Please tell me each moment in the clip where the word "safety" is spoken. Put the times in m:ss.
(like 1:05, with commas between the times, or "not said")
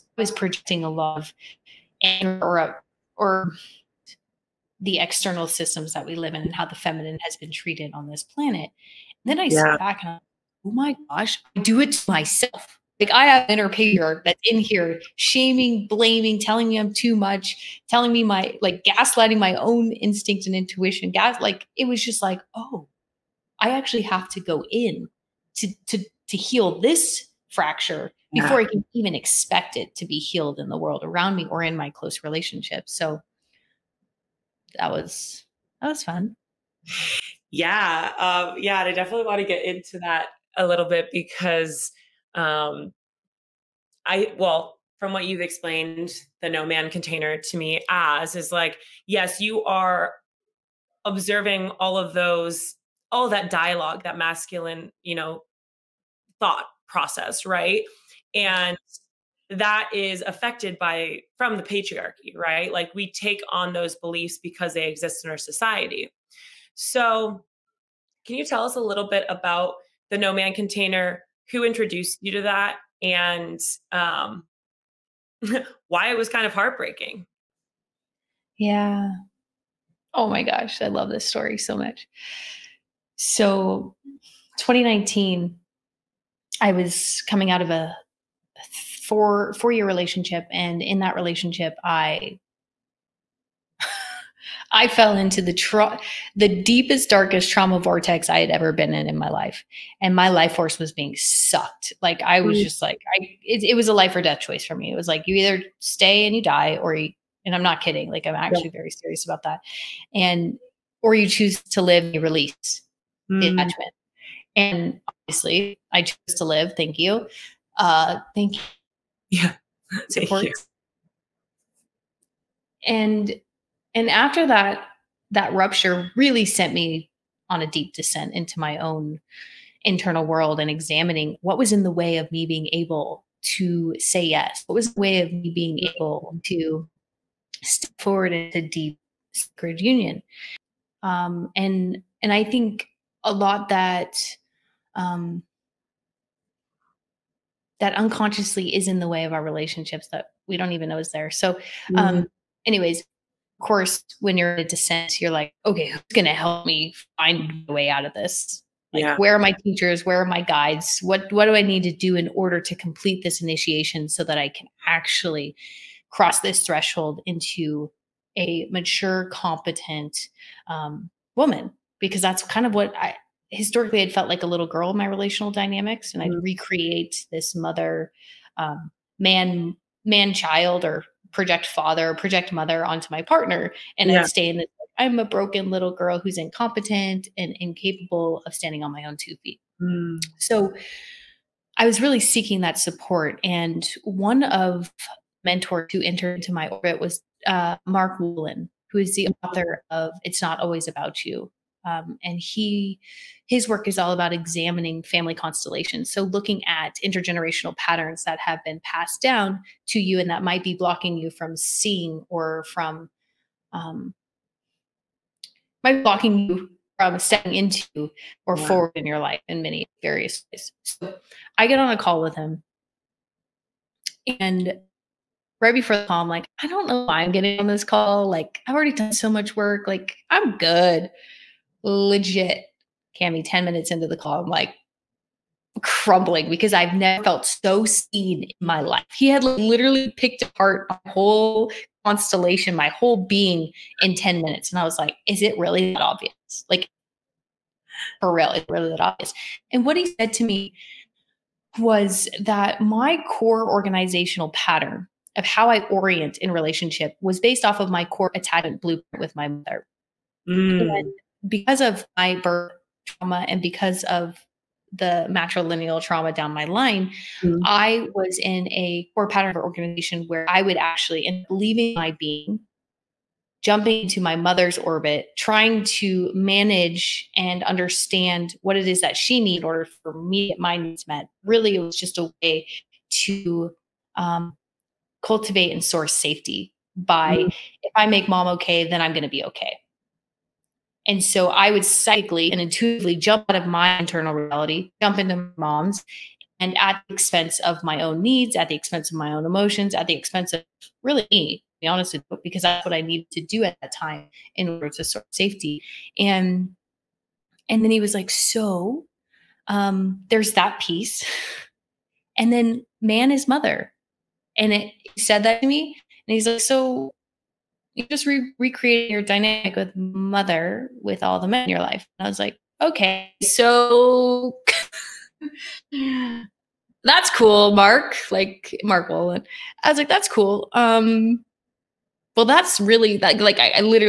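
4:46, 5:05.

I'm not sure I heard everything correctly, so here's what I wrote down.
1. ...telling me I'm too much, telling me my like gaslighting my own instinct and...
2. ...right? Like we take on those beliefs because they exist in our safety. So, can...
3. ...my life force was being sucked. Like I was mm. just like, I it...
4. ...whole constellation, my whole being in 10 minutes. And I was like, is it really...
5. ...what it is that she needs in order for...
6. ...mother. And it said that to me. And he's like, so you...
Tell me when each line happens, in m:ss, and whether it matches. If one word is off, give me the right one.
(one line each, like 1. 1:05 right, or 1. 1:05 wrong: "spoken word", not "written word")
1. 0:16 right
2. 1:02 wrong: "society", not "safety"
3. 1:40 right
4. 4:01 right
5. 4:38 right
6. 5:13 right.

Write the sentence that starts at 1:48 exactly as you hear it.
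Like I'm actually very serious about that, and or you choose to live and release mm.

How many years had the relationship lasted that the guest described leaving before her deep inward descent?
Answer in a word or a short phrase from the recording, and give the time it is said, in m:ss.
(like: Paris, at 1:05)
4, at 1:29.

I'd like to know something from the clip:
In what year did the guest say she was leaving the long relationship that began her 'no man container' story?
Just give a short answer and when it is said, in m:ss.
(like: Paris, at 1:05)
2019, at 1:24.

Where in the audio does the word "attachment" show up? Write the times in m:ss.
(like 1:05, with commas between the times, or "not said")
1:53, 4:18.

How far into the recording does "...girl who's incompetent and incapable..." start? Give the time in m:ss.
3:05.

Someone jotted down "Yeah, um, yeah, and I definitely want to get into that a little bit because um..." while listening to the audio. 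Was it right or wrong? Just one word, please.
right.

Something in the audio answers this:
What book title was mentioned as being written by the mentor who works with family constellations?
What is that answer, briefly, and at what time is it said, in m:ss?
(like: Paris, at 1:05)
It's Not Always About You, at 3:20.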